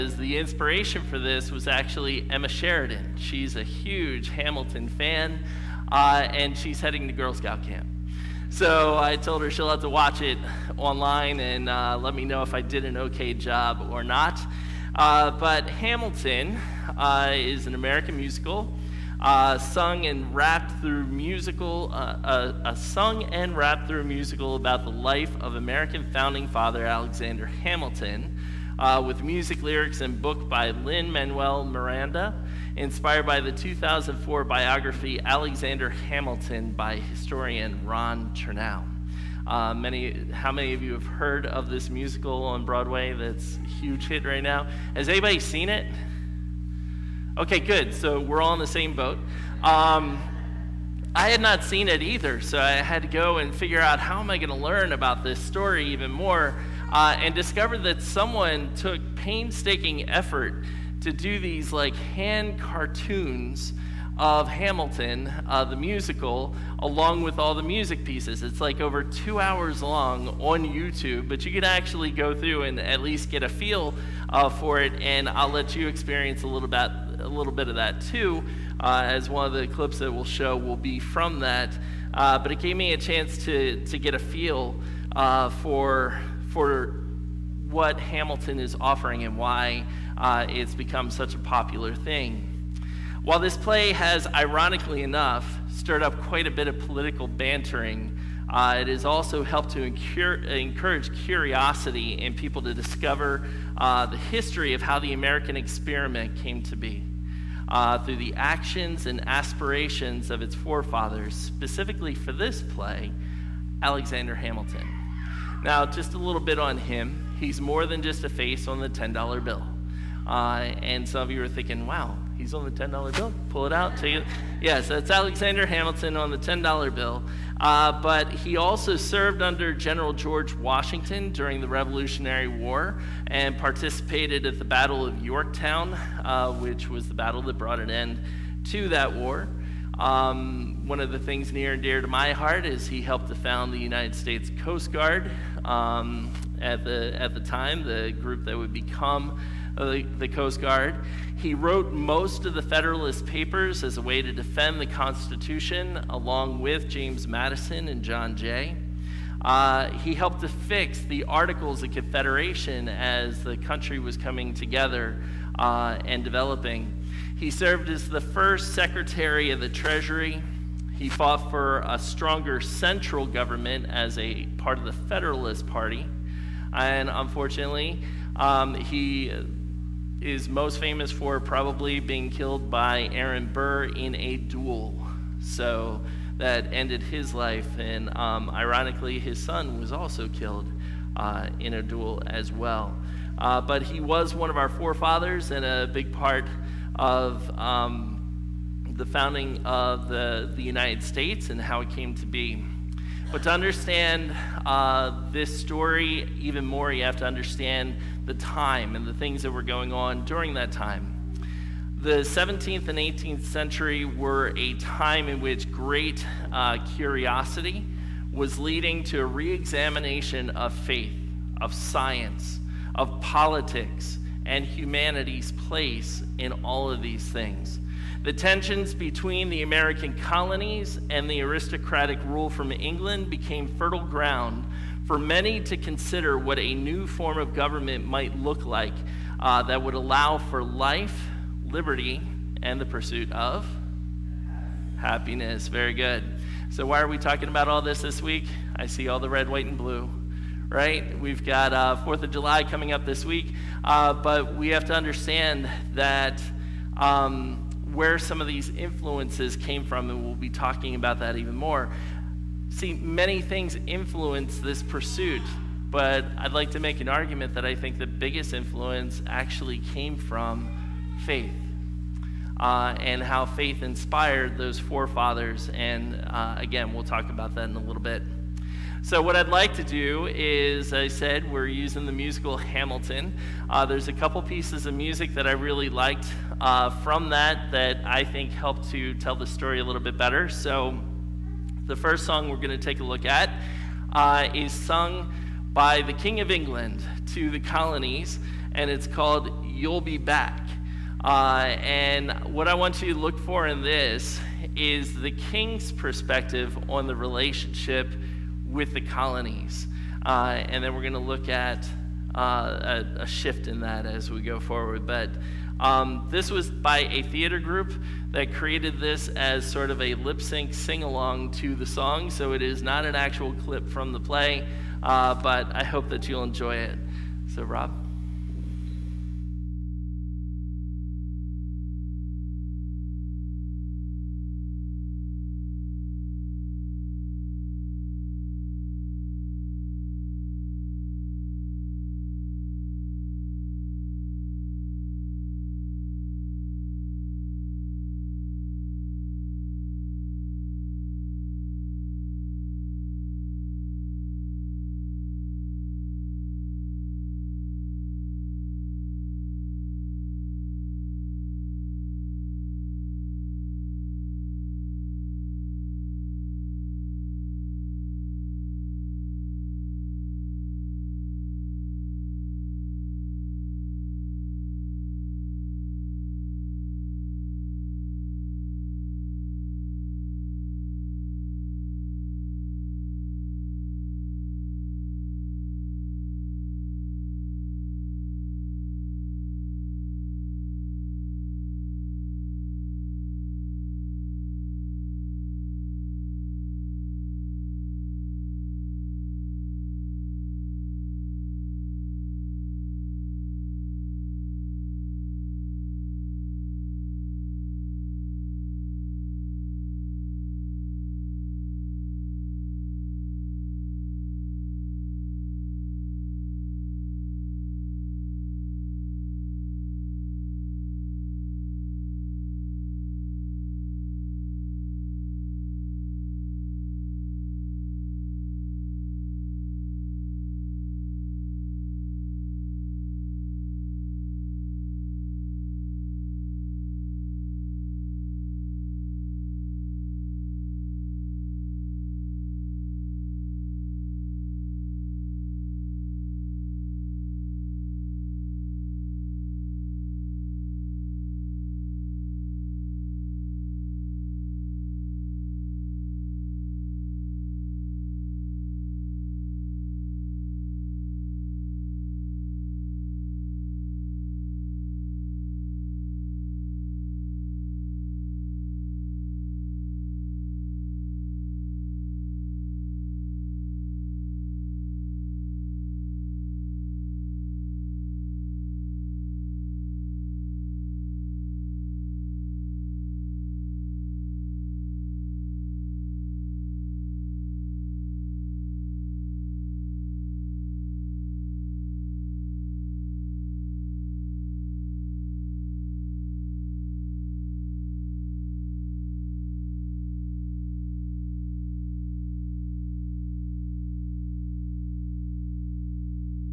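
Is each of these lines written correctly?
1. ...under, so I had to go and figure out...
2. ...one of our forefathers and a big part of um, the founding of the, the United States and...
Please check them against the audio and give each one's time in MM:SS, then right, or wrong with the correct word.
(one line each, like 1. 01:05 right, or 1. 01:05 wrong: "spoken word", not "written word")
1. 00:52 wrong: "either", not "under"
2. 03:14 right.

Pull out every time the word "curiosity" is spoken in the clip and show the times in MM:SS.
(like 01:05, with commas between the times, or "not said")
01:41, 03:36.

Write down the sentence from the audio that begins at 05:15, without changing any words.
But um, this was by a theater group that created this as sort of a lip sync sing along to the song.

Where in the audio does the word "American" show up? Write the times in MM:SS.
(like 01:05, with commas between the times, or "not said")
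00:17, 00:25, 01:45, 03:49.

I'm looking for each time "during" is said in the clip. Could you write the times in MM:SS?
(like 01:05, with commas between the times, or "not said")
02:11, 03:30.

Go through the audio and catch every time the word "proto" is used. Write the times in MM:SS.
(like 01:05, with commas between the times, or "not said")
not said.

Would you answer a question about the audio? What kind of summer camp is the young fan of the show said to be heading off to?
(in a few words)
Girl Scout camp.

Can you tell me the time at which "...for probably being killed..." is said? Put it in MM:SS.
03:01.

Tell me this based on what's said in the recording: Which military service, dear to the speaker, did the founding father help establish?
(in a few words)
United States Coast Guard.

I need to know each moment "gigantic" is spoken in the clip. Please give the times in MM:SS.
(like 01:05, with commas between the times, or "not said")
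not said.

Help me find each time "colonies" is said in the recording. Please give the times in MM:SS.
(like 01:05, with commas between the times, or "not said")
03:50, 04:57, 05:08.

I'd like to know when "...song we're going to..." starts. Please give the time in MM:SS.
04:52.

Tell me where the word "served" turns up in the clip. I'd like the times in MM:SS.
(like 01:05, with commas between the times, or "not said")
02:08, 02:47.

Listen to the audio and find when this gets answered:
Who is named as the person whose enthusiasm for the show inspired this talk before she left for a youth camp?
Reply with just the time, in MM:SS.
00:02.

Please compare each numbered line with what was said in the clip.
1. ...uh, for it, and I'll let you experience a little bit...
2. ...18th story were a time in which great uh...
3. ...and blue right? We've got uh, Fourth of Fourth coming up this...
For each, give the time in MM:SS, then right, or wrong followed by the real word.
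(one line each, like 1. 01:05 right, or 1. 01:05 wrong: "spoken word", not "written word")
1. 01:14 right
2. 03:32 wrong: "century", not "story"
3. 04:09 wrong: "July", not "Fourth".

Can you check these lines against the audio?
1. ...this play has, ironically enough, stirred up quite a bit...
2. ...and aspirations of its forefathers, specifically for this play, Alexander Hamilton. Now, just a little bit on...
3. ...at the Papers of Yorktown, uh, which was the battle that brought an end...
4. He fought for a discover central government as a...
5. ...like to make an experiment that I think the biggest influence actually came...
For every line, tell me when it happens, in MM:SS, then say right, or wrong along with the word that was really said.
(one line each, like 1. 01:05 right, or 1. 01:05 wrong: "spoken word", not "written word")
1. 01:33 right
2. 01:49 right
3. 02:14 wrong: "Battle", not "Papers"
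4. 02:50 wrong: "stronger", not "discover"
5. 04:26 wrong: "argument", not "experiment".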